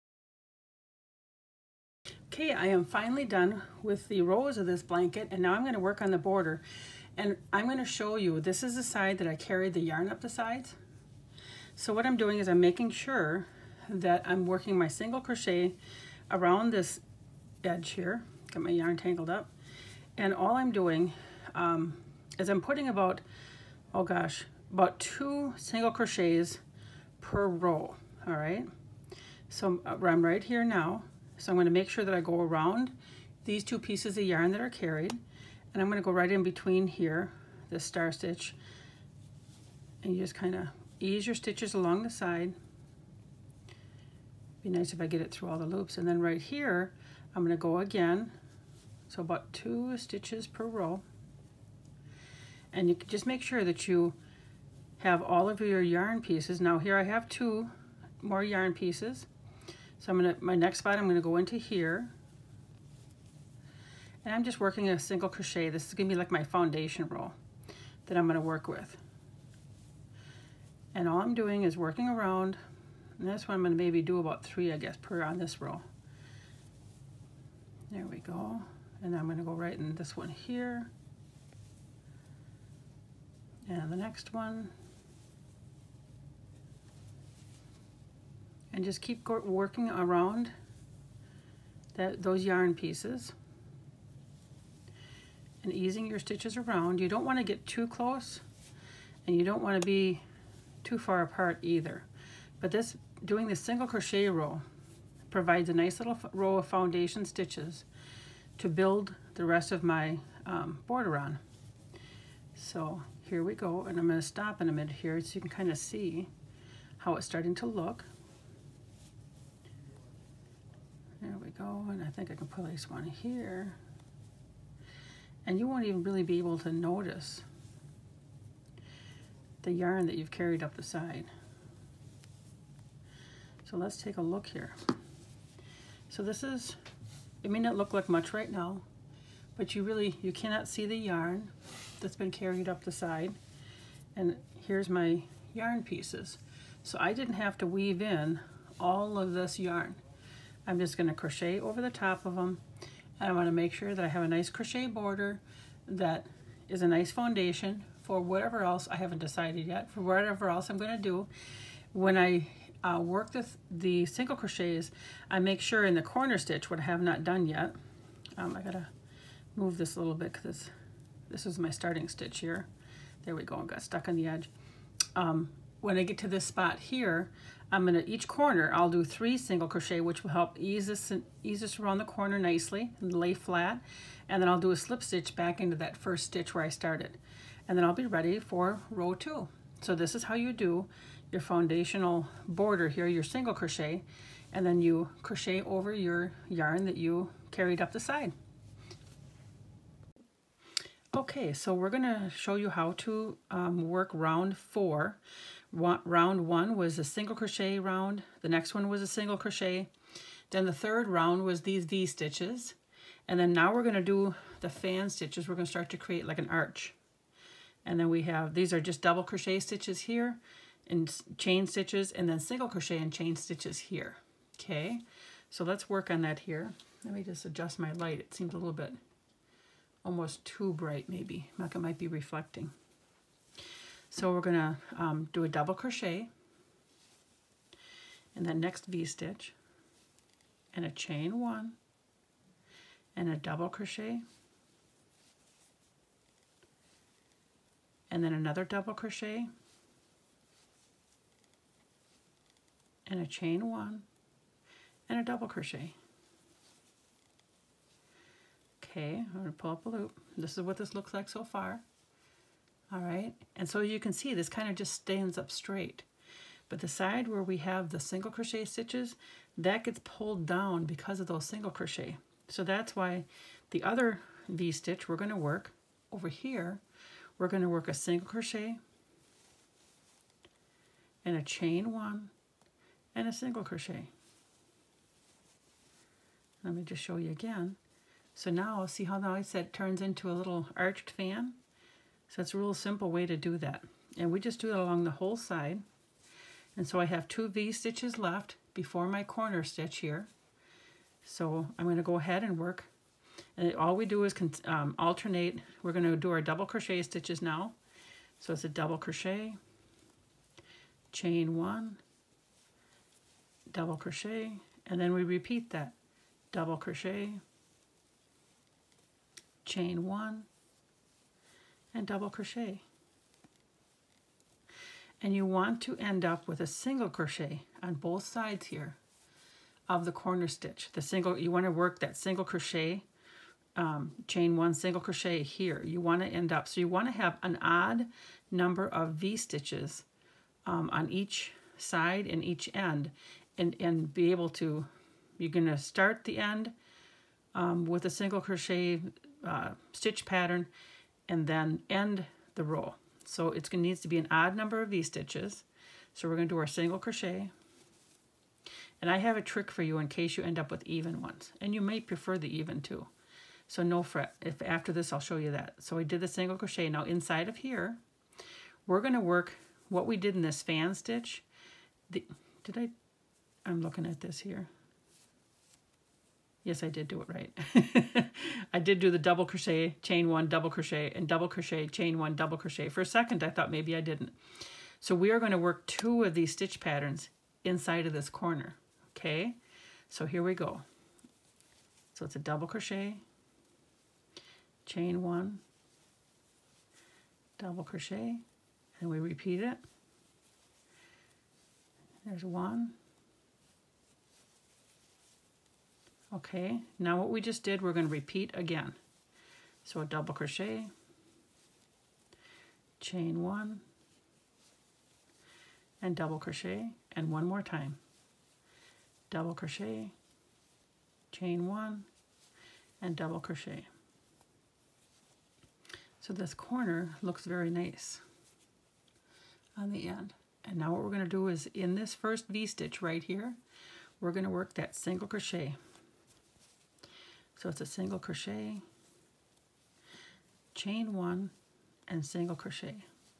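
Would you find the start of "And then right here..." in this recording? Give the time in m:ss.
0:45.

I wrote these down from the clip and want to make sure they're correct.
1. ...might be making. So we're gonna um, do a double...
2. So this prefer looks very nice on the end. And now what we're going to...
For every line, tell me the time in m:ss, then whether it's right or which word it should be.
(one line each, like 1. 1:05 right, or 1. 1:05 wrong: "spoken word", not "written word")
1. 3:51 wrong: "reflecting", not "making"
2. 7:06 wrong: "corner", not "prefer".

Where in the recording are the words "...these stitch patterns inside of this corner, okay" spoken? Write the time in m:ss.
6:26.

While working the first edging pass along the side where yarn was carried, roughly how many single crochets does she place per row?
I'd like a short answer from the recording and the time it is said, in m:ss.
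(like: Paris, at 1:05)
2, at 0:24.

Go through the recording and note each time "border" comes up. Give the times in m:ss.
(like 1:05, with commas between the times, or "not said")
0:06, 1:50, 2:34, 3:12.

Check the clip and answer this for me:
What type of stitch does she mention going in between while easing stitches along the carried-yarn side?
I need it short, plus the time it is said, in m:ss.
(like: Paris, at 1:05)
star stitch, at 0:37.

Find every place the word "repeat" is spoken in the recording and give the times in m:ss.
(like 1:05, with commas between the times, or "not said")
5:15, 6:39, 6:48.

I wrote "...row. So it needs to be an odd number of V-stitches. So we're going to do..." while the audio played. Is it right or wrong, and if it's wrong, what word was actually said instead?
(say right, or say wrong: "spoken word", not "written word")
right.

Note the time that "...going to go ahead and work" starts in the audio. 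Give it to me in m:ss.
5:01.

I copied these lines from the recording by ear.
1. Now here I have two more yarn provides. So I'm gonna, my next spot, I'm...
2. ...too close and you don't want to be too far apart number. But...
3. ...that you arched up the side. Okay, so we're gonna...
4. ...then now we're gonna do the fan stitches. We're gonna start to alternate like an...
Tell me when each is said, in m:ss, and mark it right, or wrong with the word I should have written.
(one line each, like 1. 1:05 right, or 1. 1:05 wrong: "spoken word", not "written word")
1. 0:56 wrong: "pieces", not "provides"
2. 1:37 wrong: "either", not "number"
3. 3:16 wrong: "carried", not "arched"
4. 3:33 wrong: "create", not "alternate".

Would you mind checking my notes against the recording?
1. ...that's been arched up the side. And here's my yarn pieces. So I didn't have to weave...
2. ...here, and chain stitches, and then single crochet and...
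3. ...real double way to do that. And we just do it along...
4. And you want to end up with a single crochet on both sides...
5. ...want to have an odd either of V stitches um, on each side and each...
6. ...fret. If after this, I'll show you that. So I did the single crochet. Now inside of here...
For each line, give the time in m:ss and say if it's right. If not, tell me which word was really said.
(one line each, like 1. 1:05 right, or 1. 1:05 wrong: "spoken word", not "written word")
1. 2:21 wrong: "carried", not "arched"
2. 3:40 right
3. 4:52 wrong: "simple", not "double"
4. 5:25 right
5. 5:36 wrong: "number", not "either"
6. 6:04 right.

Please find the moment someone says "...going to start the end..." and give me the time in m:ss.
5:45.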